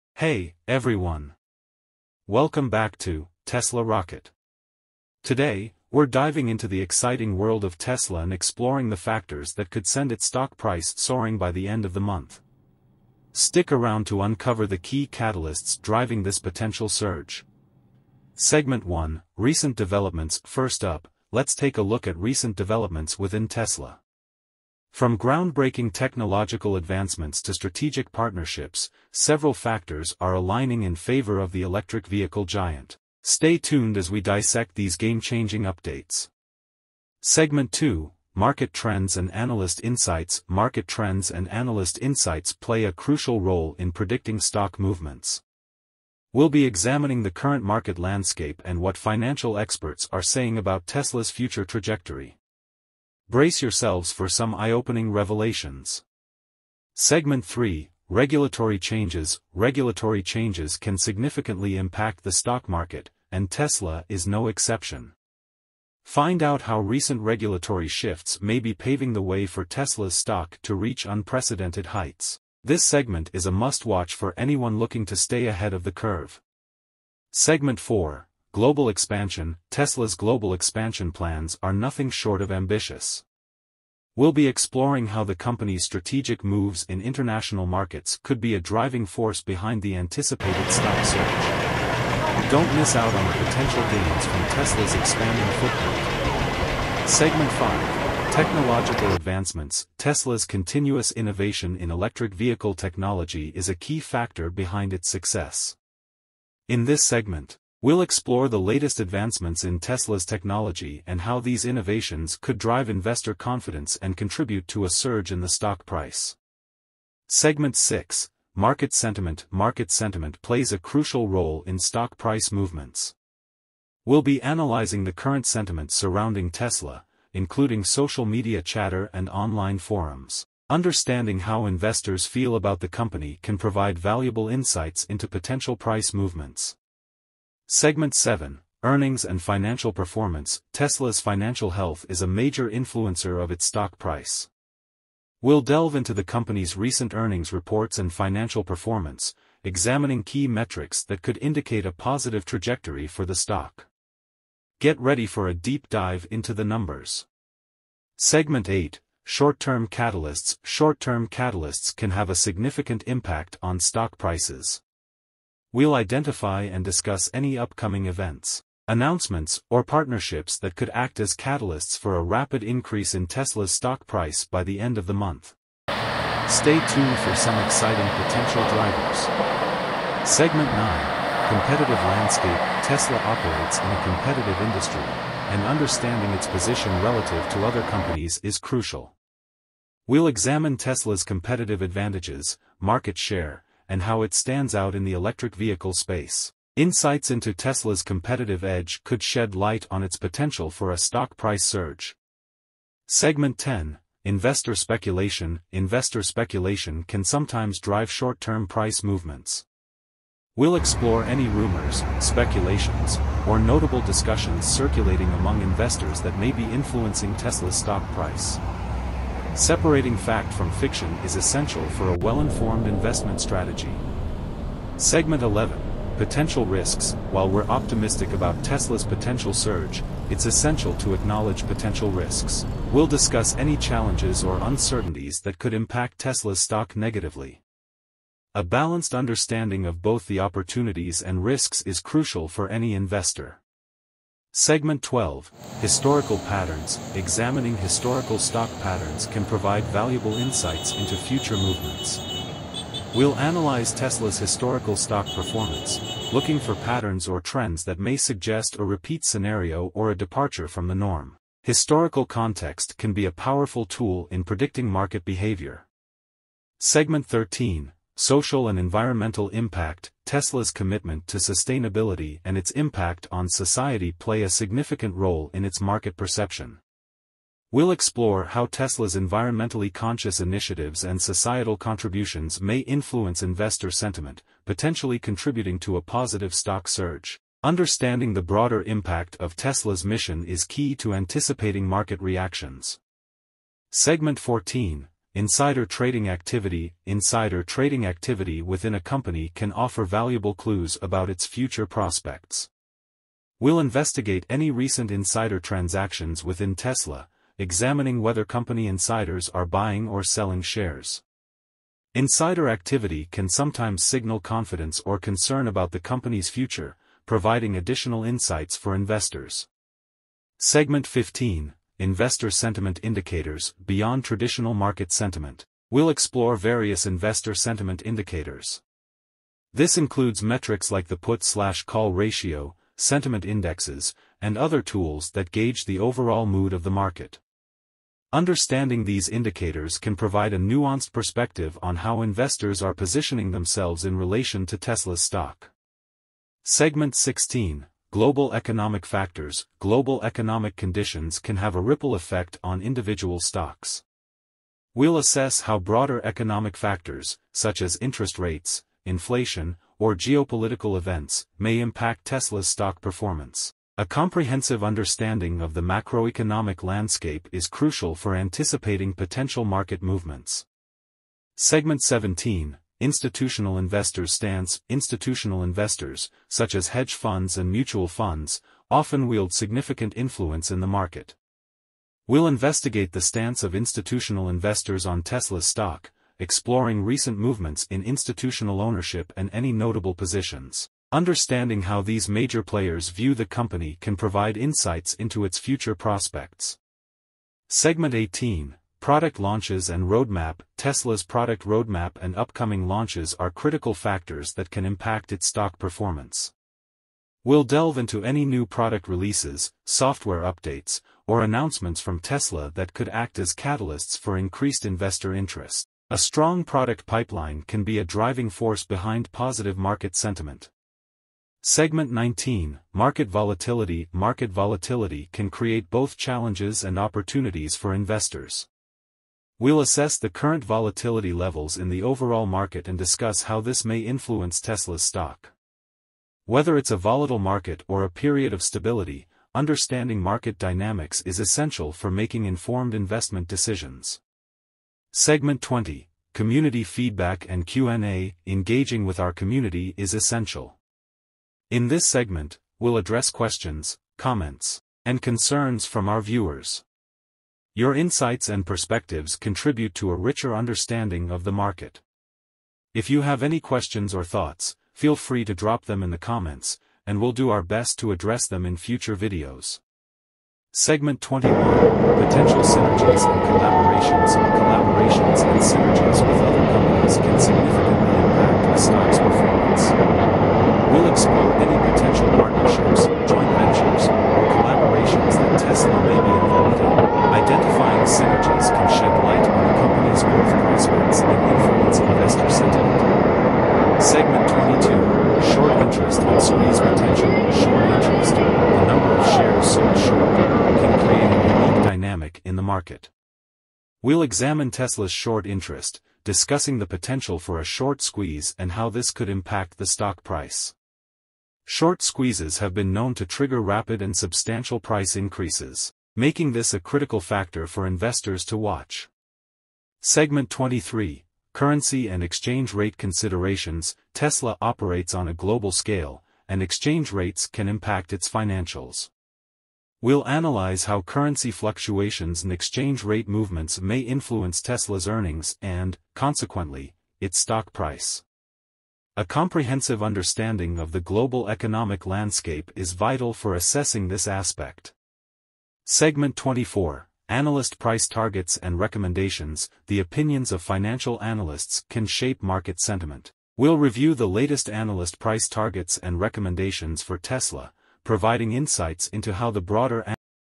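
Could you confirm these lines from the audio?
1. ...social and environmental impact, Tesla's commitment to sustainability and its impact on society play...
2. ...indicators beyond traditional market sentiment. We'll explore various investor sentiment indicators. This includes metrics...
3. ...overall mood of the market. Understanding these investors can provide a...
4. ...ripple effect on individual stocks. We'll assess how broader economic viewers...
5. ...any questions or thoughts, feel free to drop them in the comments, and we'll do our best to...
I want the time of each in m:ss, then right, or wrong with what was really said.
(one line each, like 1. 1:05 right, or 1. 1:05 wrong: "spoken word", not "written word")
1. 4:28 right
2. 5:23 right
3. 5:35 wrong: "indicators", not "investors"
4. 5:51 wrong: "factors", not "viewers"
5. 7:43 right.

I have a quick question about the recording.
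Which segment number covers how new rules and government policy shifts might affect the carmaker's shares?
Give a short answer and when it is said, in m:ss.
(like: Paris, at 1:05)
3, at 0:56.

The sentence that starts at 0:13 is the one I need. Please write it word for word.
Stick around to uncover the key catalysts driving this potential surge.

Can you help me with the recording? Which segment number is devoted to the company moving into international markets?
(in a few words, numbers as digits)
4.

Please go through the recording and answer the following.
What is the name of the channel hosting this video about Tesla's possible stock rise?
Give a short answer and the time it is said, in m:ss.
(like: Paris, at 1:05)
Tesla Rocket, at 0:03.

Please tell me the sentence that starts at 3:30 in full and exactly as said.
We'll explore any rumors, speculations, or notable discussions circulating among investors that may be influencing Tesla's stock price.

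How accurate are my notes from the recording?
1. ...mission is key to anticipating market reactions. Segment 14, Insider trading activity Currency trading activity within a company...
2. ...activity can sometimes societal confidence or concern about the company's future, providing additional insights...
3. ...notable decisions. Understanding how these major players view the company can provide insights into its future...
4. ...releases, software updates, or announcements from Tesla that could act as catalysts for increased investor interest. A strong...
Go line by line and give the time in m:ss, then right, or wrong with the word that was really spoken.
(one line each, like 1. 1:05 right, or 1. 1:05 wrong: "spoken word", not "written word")
1. 4:50 wrong: "Insider", not "Currency"
2. 5:12 wrong: "signal", not "societal"
3. 6:29 wrong: "positions", not "decisions"
4. 6:49 right.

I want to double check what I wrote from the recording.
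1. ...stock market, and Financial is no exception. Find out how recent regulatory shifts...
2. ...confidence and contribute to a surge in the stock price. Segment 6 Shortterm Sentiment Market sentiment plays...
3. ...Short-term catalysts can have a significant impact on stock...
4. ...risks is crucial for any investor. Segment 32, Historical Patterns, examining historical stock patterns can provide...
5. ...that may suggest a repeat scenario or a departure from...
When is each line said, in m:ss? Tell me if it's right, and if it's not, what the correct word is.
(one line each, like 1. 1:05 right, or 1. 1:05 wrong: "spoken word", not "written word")
1. 1:02 wrong: "Tesla", not "Financial"
2. 1:53 wrong: "Market", not "Shortterm"
3. 2:40 right
4. 4:01 wrong: "12", not "32"
5. 4:17 right.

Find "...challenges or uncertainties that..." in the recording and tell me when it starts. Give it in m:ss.
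3:53.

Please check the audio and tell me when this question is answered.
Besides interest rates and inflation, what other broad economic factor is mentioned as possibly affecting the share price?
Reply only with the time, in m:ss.
6:00.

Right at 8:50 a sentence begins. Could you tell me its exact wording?
We'll analyze how currency fluctuations and exchange rate movements may influence Tesla's earnings and, consequently, its stock price.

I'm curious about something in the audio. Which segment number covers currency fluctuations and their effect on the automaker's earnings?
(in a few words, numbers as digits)
23.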